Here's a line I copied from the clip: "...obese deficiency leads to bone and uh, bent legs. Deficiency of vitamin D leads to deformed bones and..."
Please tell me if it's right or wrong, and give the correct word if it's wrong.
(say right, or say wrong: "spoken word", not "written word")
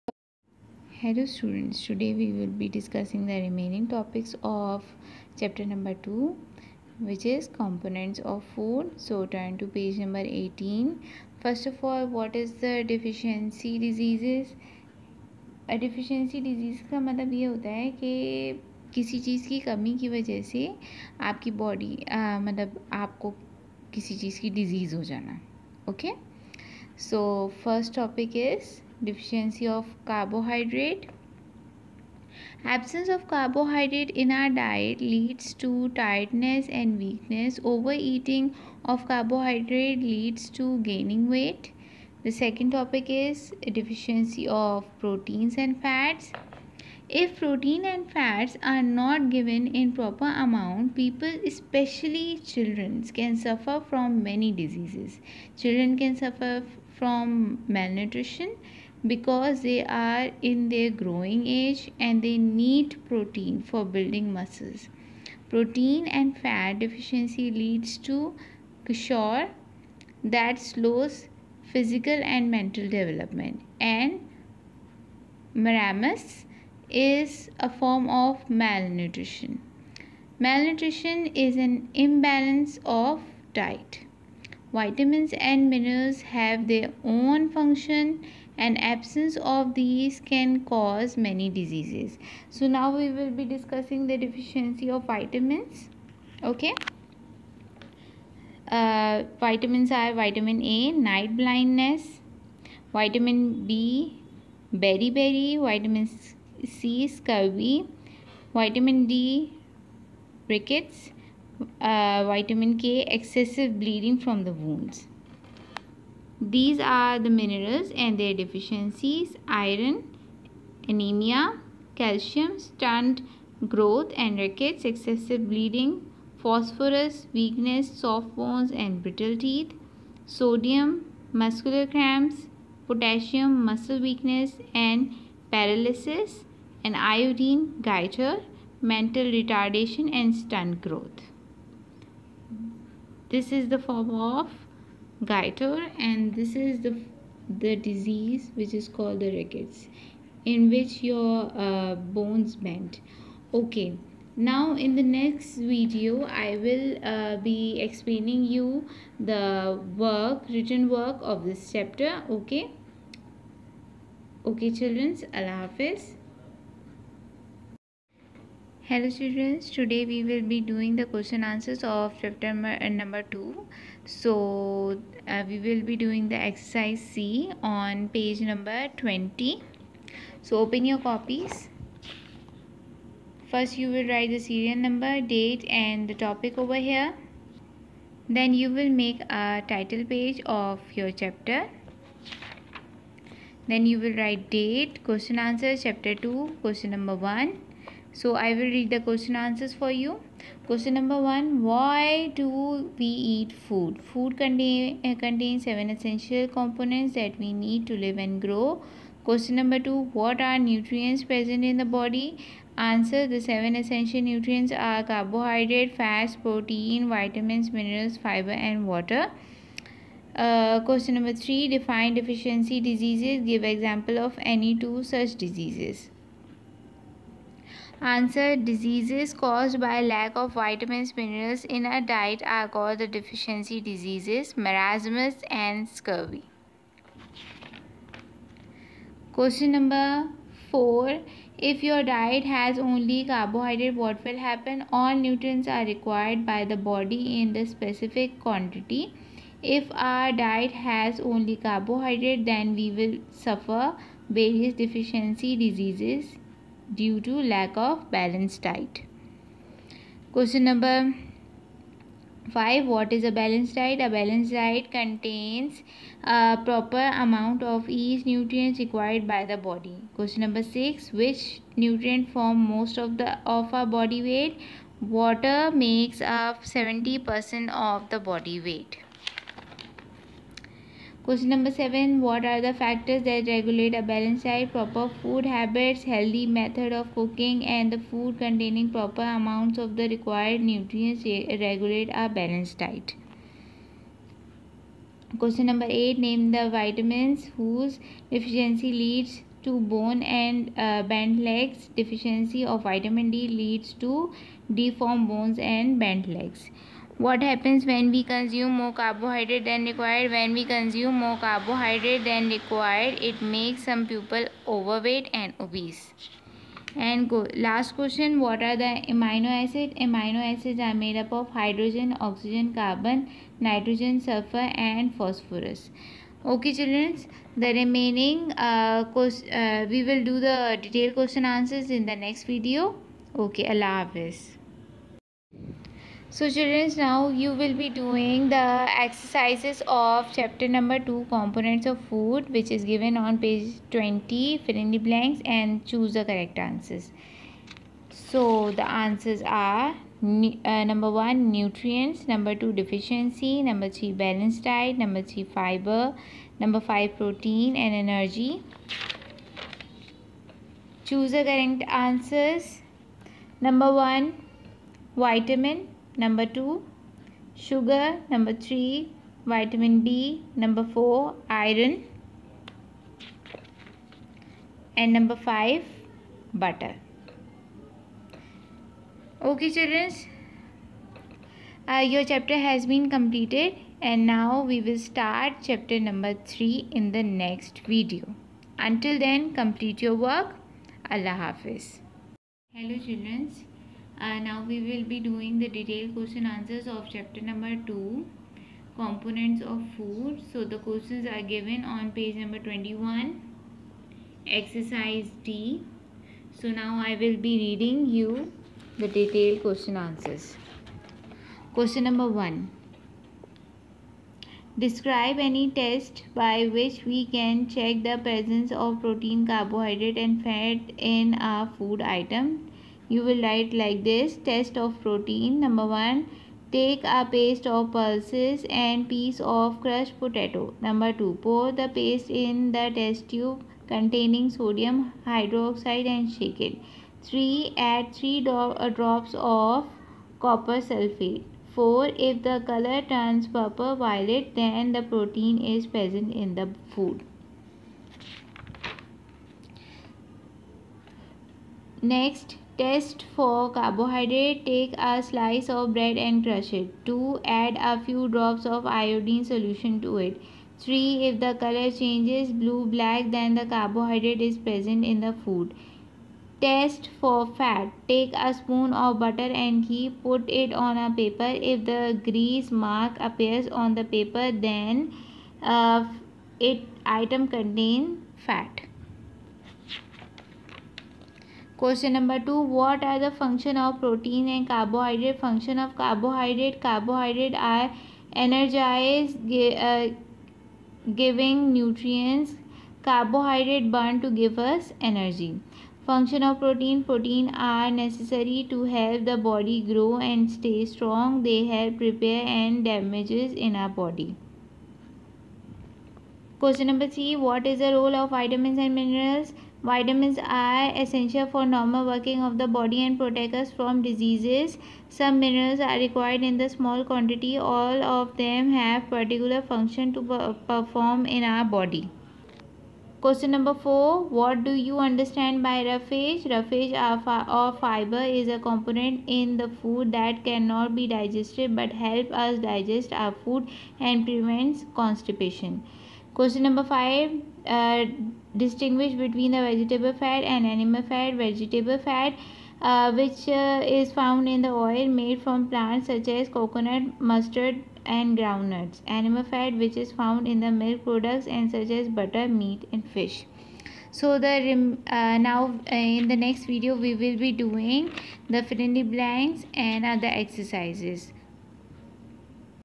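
wrong: "whose", not "obese".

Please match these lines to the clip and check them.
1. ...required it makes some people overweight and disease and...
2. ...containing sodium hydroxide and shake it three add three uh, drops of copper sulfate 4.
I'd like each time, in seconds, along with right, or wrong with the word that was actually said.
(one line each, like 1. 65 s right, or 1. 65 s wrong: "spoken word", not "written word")
1. 312 s wrong: "obese", not "disease"
2. 433 s right.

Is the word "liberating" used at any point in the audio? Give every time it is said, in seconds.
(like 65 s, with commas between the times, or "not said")
not said.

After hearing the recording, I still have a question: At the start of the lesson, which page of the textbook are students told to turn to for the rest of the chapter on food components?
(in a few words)
18.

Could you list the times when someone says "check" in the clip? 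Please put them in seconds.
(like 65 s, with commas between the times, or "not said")
417 s.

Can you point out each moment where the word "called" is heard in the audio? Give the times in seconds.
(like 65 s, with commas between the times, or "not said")
148 s, 232 s.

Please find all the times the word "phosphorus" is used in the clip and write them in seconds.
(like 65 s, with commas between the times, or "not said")
126 s, 325 s.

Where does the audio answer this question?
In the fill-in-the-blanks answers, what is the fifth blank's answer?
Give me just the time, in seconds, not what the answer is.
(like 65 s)
357 s.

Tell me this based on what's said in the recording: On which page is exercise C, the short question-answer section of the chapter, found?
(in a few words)
20.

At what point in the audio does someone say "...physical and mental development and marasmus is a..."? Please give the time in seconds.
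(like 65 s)
71 s.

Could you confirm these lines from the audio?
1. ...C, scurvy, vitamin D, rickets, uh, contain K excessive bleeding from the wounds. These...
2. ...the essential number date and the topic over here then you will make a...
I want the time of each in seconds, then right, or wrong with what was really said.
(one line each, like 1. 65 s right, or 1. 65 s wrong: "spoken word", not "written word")
1. 106 s wrong: "vitamin", not "contain"
2. 184 s wrong: "serial", not "essential".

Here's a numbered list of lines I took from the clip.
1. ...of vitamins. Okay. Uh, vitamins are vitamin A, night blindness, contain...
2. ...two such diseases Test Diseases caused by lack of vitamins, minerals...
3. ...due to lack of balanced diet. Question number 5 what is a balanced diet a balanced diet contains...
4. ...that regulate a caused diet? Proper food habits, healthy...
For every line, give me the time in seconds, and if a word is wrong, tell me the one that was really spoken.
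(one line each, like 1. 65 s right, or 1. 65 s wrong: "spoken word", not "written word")
1. 94 s wrong: "vitamin", not "contain"
2. 224 s wrong: "Answer", not "Test"
3. 256 s right
4. 283 s wrong: "balanced", not "caused".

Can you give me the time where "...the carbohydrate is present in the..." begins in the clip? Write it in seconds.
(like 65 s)
463 s.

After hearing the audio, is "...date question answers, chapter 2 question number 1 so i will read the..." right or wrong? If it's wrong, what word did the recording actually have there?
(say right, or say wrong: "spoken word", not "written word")
right.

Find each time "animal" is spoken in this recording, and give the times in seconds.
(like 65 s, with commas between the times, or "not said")
540 s, 549 s.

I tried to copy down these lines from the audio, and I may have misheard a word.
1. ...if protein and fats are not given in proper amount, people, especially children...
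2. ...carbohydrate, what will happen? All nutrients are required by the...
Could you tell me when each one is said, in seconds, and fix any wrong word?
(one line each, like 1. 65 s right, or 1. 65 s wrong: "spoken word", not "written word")
1. 47 s right
2. 243 s right.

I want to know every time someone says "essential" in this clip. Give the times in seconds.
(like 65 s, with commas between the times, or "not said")
205 s, 213 s, 510 s.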